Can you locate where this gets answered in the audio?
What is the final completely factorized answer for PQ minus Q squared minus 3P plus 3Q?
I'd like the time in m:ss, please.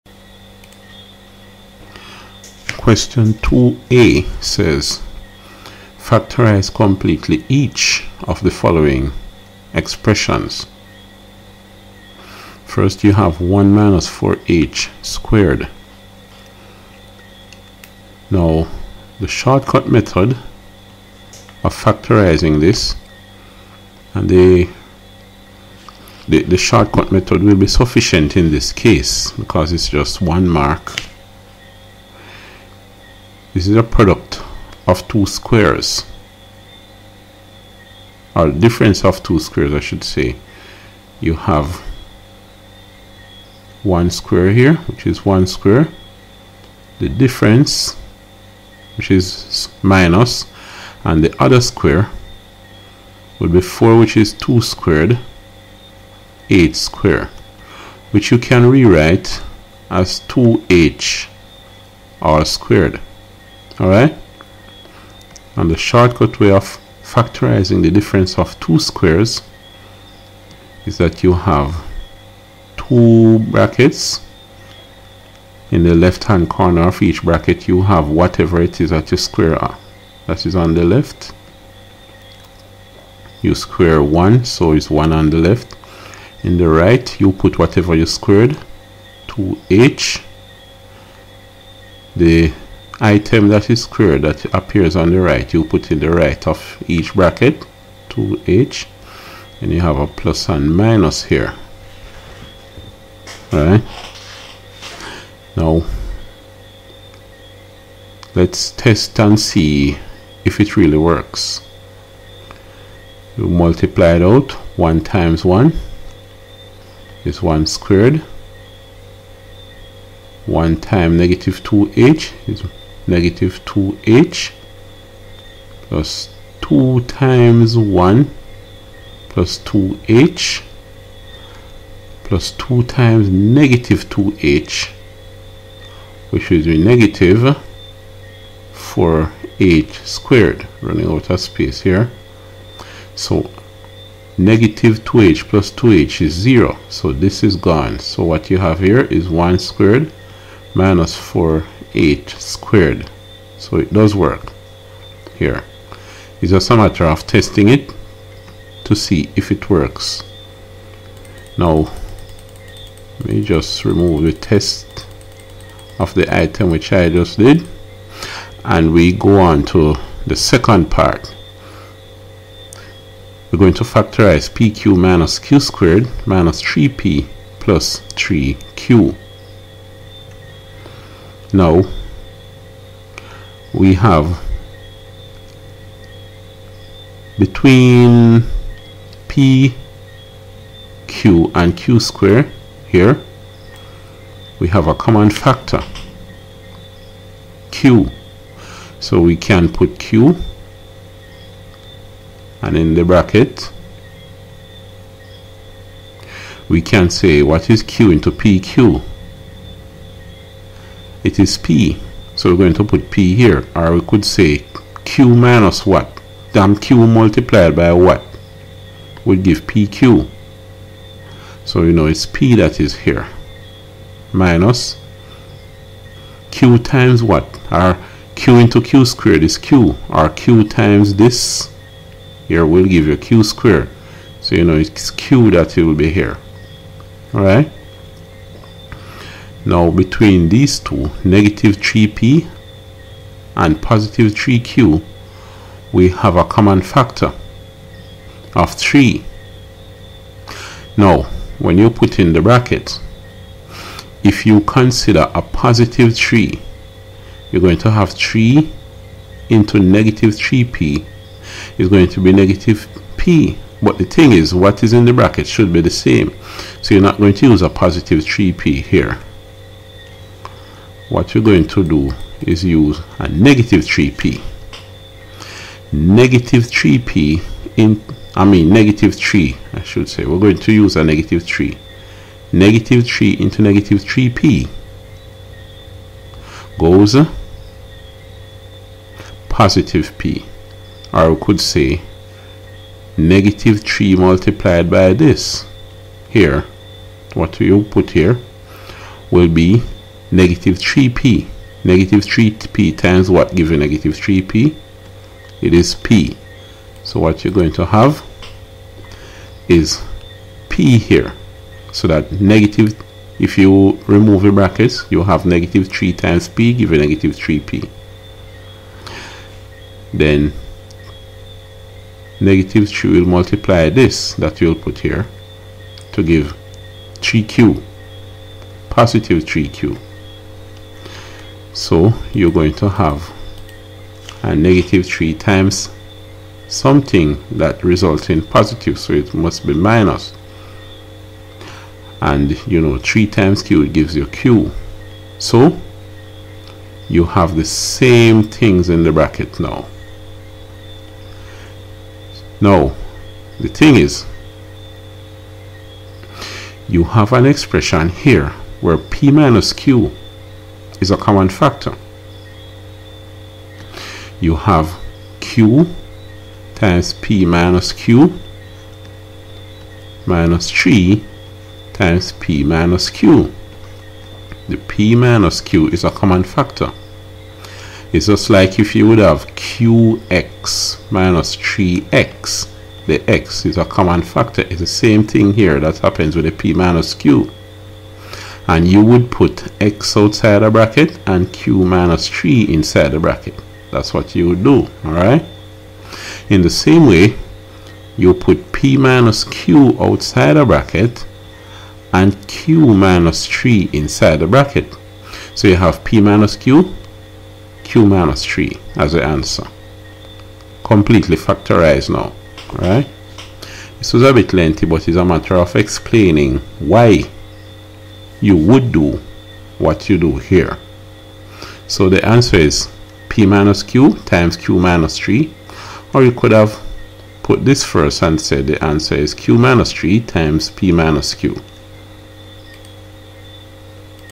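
7:03.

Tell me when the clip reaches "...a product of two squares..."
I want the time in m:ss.
0:33.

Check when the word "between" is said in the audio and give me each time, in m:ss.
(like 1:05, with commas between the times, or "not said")
3:07, 3:59.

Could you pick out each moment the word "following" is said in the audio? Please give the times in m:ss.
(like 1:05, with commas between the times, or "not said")
0:08.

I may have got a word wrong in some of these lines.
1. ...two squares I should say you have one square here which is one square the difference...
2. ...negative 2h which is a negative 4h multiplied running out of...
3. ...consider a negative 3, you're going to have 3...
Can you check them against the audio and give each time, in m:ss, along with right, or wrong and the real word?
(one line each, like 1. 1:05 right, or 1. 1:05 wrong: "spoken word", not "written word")
1. 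0:39 right
2. 2:13 wrong: "squared", not "multiplied"
3. 4:14 wrong: "positive", not "negative".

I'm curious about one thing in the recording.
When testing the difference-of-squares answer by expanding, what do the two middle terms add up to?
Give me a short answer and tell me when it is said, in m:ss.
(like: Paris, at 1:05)
0, at 2:26.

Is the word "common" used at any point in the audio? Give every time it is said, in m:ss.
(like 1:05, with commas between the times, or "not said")
3:14, 4:06, 6:01, 6:16, 6:23.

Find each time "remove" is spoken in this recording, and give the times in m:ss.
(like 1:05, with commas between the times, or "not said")
2:43, 5:14.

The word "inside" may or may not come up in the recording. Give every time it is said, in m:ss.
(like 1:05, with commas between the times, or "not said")
6:32, 6:43.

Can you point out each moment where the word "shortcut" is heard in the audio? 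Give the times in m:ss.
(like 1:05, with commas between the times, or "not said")
0:19, 0:26, 1:05.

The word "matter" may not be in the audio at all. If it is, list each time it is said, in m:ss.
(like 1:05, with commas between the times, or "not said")
2:36, 6:55.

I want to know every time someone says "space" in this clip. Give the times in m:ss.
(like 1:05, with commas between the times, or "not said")
2:21.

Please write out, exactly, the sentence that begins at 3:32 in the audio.
So we're going to put P here.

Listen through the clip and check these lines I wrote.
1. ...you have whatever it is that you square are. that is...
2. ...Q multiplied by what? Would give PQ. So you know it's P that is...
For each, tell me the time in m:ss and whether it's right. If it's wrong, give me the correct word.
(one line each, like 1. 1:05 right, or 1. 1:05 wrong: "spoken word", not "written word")
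1. 1:17 right
2. 3:36 right.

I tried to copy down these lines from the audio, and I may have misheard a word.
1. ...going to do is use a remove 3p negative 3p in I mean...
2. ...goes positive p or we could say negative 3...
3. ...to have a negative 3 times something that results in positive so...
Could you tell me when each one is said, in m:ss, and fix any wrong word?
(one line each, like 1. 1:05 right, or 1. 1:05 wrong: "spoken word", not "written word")
1. 4:31 wrong: "negative", not "remove"
2. 4:46 right
3. 5:32 right.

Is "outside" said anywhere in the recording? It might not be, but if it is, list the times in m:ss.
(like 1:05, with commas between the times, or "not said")
6:30, 6:39.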